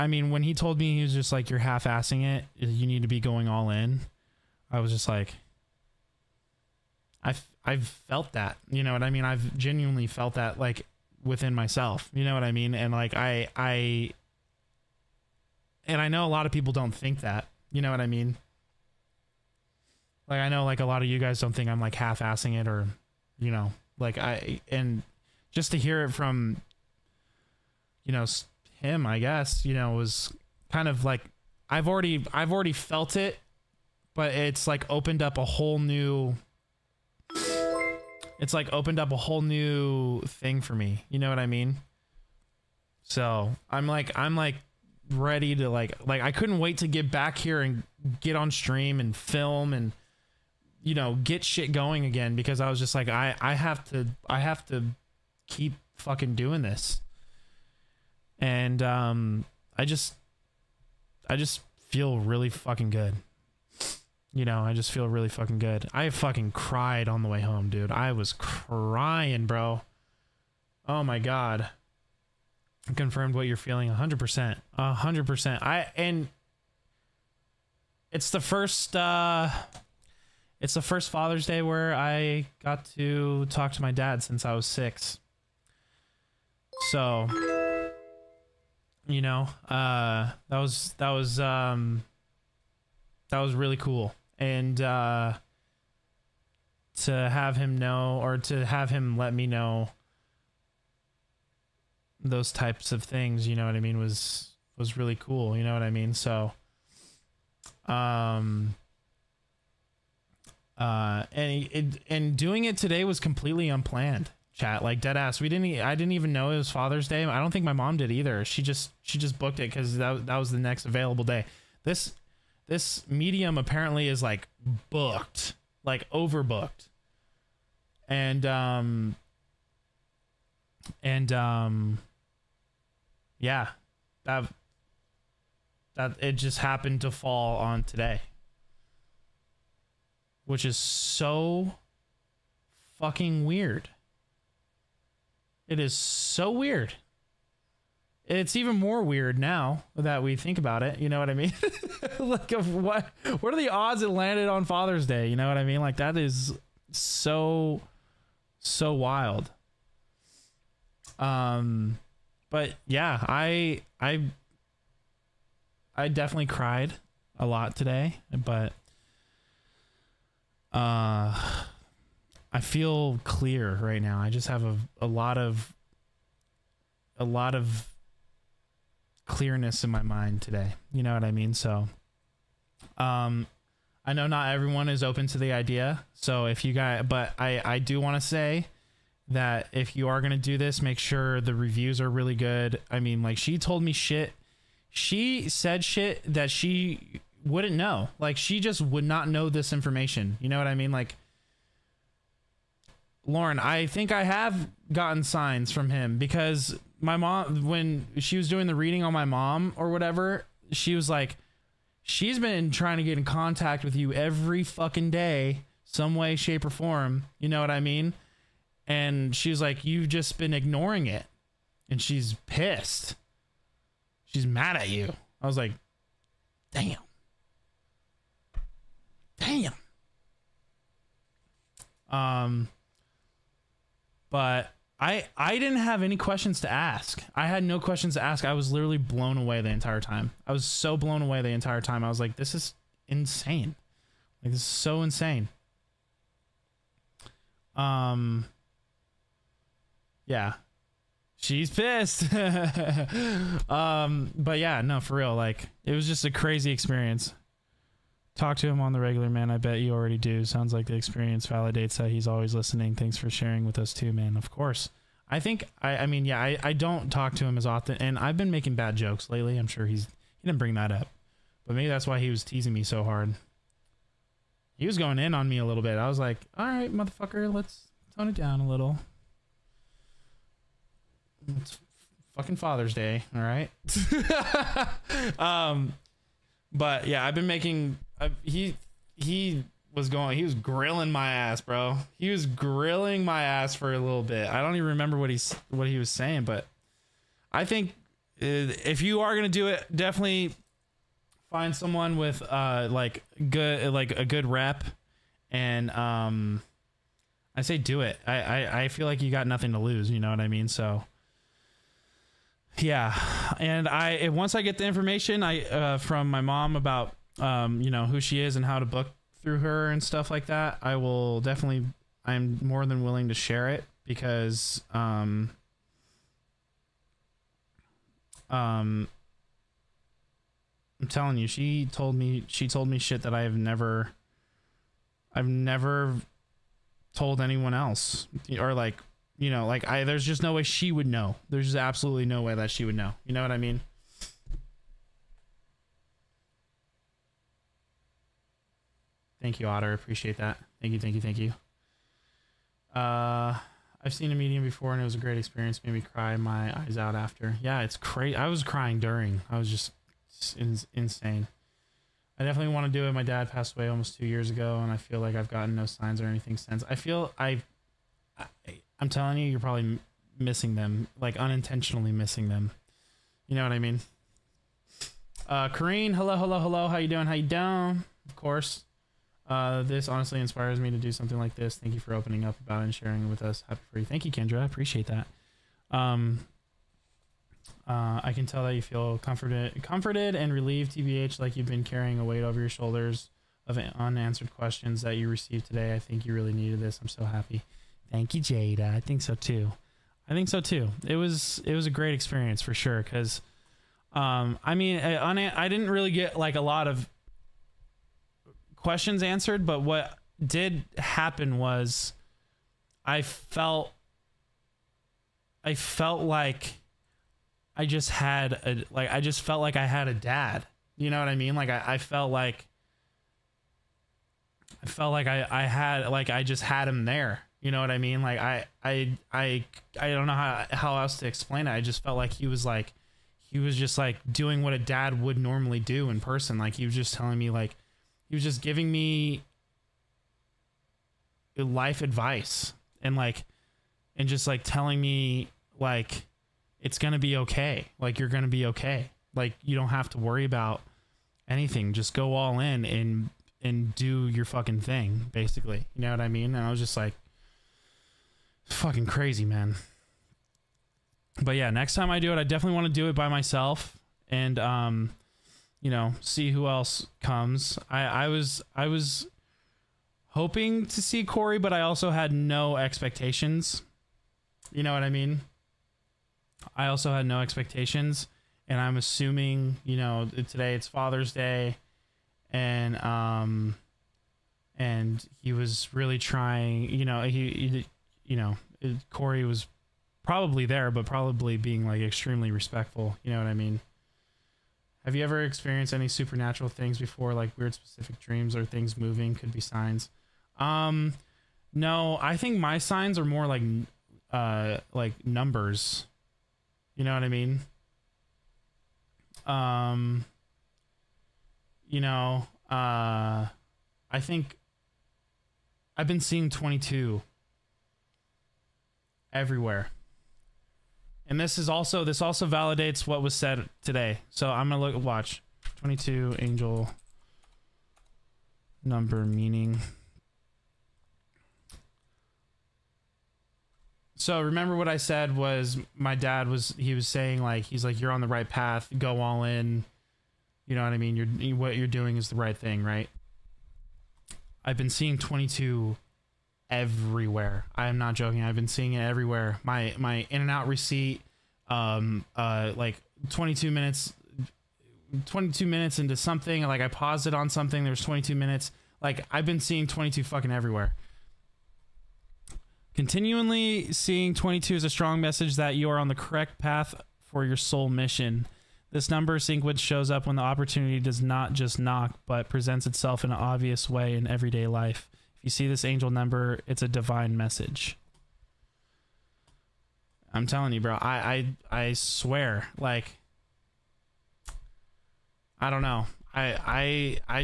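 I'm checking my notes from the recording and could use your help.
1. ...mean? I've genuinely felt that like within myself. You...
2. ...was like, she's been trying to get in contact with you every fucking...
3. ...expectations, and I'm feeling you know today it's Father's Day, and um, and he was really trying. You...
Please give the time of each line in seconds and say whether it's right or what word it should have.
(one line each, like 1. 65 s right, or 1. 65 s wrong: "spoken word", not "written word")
1. 9 s right
2. 210 s right
3. 477 s wrong: "assuming", not "feeling".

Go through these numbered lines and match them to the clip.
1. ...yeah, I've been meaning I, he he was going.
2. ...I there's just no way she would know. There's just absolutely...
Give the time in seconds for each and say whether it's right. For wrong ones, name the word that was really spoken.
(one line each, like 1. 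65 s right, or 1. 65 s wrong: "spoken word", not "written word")
1. 287 s wrong: "making", not "meaning"
2. 339 s right.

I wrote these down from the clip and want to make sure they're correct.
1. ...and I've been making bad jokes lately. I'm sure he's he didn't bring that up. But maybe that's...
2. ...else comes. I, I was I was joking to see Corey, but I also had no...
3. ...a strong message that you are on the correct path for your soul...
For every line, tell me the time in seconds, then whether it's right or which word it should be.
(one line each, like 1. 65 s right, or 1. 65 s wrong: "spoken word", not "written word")
1. 268 s right
2. 466 s wrong: "hoping", not "joking"
3. 564 s right.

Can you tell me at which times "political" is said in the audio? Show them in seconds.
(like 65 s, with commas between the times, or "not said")
not said.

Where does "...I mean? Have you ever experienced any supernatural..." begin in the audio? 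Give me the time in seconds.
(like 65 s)
493 s.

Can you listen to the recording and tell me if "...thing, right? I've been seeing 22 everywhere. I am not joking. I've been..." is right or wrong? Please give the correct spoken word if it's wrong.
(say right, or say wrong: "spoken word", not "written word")
right.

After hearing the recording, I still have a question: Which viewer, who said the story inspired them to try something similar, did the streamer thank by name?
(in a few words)
Kendra.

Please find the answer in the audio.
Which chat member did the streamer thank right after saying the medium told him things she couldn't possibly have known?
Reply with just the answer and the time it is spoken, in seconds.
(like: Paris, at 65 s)
Otter, at 349 s.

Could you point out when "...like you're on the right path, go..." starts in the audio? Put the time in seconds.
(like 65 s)
537 s.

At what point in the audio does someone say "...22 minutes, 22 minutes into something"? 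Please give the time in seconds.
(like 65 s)
553 s.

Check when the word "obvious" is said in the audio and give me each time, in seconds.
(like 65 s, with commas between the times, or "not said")
573 s.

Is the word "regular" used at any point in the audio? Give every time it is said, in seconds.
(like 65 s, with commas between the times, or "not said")
258 s.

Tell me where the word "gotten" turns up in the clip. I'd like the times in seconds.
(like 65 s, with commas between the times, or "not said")
204 s, 365 s.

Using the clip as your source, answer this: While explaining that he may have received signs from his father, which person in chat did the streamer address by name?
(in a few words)
Lauren.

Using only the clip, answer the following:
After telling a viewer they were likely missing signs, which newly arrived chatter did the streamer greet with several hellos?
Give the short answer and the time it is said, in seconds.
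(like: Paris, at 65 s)
Kareen, at 375 s.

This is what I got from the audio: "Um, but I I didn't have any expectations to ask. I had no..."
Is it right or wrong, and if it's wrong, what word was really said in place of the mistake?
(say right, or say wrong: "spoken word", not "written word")
wrong: "questions", not "expectations".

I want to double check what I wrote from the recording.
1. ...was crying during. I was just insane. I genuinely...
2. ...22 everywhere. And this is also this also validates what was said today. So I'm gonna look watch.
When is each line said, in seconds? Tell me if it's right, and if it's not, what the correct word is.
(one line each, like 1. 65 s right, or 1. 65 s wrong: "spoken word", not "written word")
1. 358 s wrong: "definitely", not "genuinely"
2. 516 s right.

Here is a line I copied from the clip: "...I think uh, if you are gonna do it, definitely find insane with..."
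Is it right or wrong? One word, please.
wrong.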